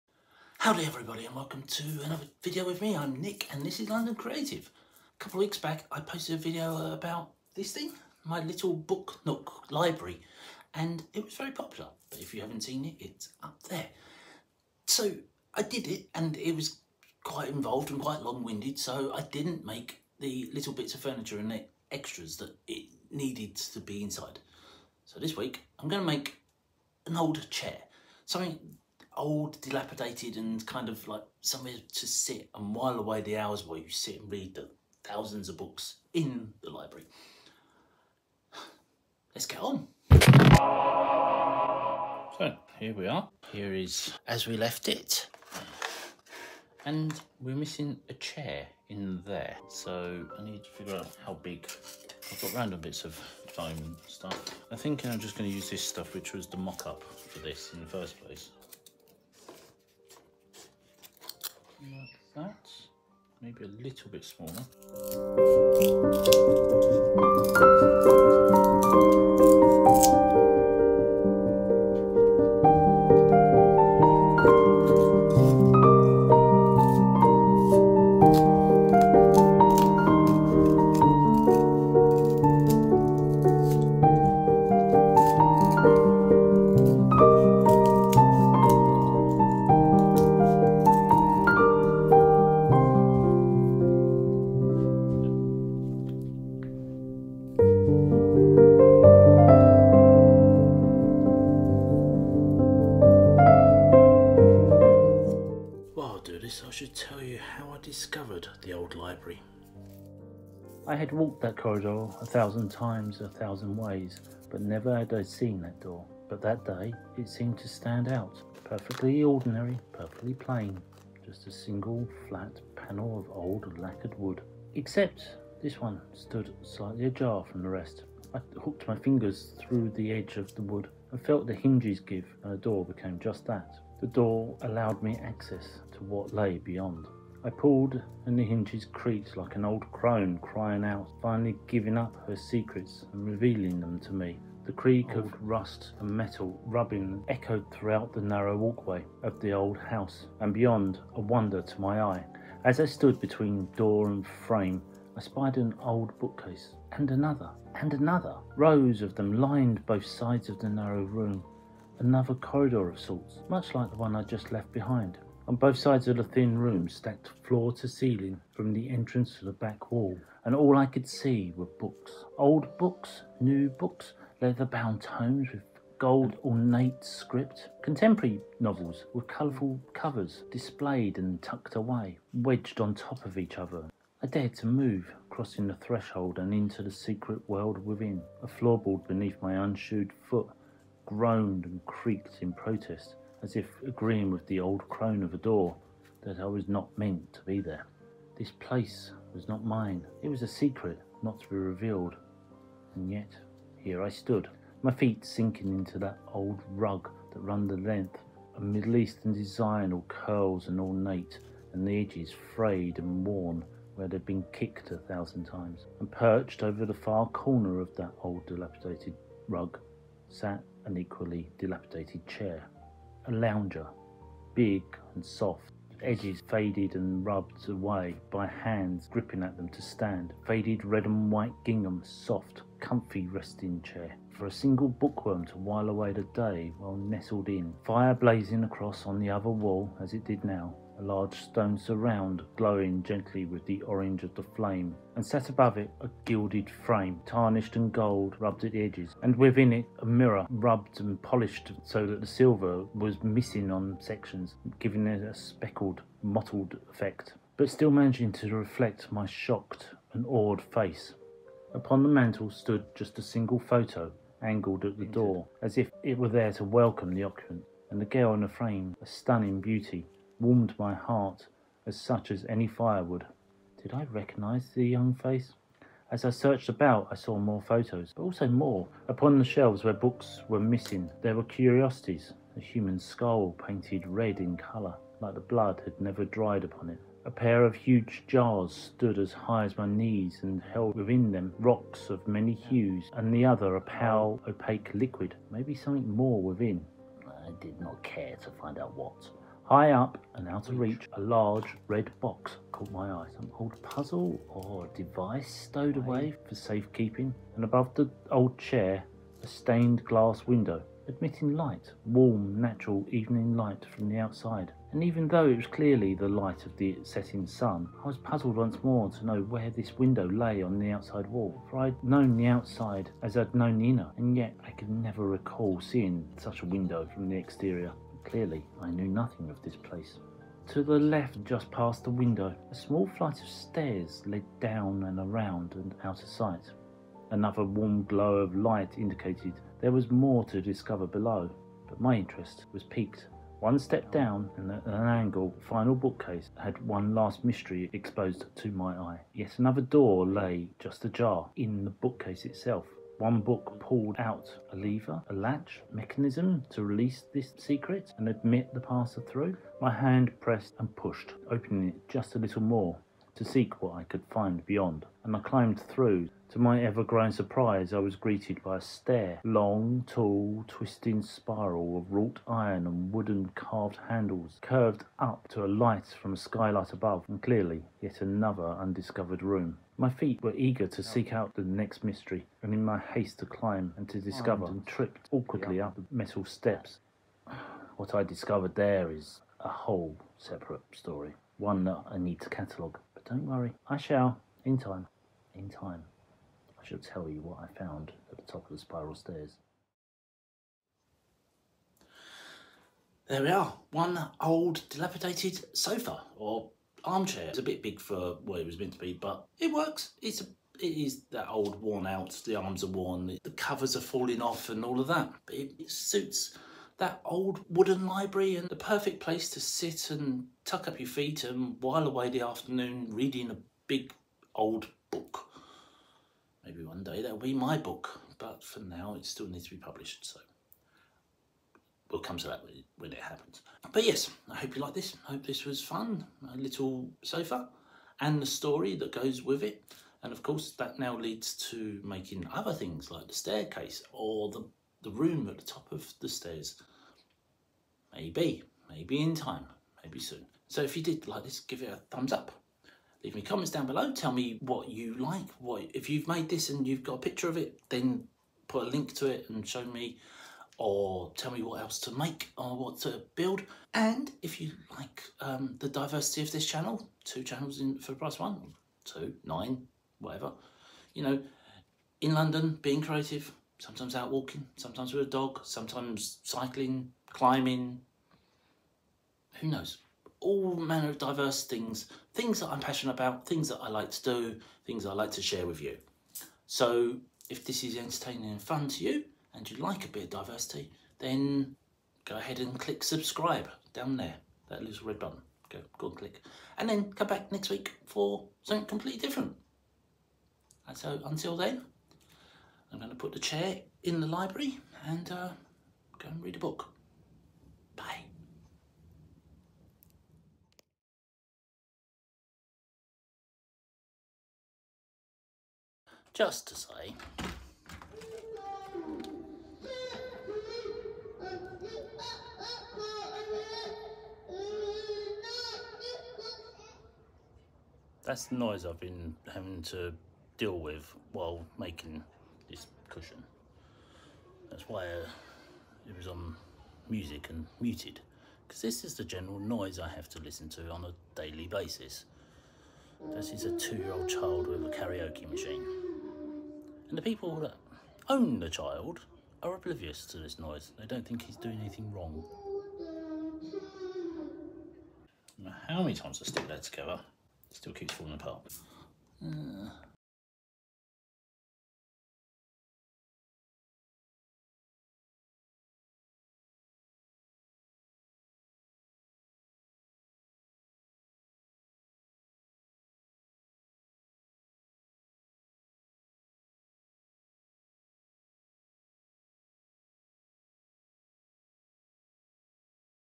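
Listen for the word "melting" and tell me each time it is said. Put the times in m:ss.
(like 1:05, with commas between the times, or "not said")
not said.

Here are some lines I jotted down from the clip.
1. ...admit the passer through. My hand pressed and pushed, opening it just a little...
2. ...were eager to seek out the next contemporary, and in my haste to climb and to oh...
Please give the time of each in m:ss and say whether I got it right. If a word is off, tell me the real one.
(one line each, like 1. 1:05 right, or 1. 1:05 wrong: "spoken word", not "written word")
1. 5:58 right
2. 6:20 wrong: "mystery", not "contemporary".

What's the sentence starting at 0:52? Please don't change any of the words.
I've got random bits of foam and stuff.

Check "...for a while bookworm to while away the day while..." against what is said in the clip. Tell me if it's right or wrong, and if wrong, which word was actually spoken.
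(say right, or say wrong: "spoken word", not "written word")
wrong: "single", not "while".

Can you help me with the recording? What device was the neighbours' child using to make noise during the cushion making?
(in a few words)
a karaoke machine.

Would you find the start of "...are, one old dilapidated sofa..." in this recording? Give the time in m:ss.
6:43.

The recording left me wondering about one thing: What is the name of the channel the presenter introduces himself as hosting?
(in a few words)
London Creative.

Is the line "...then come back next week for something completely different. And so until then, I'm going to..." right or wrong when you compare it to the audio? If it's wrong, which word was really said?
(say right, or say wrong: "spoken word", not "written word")
right.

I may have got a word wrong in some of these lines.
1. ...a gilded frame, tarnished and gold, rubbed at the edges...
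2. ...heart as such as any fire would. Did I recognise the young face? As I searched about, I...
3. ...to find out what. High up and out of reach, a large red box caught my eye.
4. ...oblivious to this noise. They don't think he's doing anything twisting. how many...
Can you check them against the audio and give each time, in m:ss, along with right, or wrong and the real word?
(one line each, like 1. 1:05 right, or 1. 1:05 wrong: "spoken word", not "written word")
1. 4:06 right
2. 4:30 right
3. 4:58 right
4. 9:09 wrong: "wrong", not "twisting".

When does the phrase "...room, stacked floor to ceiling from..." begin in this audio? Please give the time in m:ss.
2:46.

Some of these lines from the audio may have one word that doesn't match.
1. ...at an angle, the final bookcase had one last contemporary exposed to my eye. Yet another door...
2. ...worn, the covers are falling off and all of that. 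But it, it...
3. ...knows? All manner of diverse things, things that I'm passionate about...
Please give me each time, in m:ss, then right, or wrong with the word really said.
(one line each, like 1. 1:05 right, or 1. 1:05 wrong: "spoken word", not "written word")
1. 5:44 wrong: "mystery", not "contemporary"
2. 6:52 right
3. 7:59 right.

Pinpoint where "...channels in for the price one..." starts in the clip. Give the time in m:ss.
7:47.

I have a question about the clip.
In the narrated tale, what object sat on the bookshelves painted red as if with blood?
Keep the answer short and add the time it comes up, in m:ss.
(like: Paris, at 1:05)
A human skull, at 4:42.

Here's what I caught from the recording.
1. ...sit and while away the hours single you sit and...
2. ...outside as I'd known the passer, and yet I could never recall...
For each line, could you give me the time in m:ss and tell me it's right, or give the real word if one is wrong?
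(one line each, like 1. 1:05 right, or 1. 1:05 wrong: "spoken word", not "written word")
1. 0:32 wrong: "while", not "single"
2. 5:22 wrong: "inner", not "passer".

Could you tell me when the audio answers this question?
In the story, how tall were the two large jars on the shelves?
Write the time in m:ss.
4:49.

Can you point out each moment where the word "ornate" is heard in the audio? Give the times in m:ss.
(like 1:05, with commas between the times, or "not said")
2:56, 3:30.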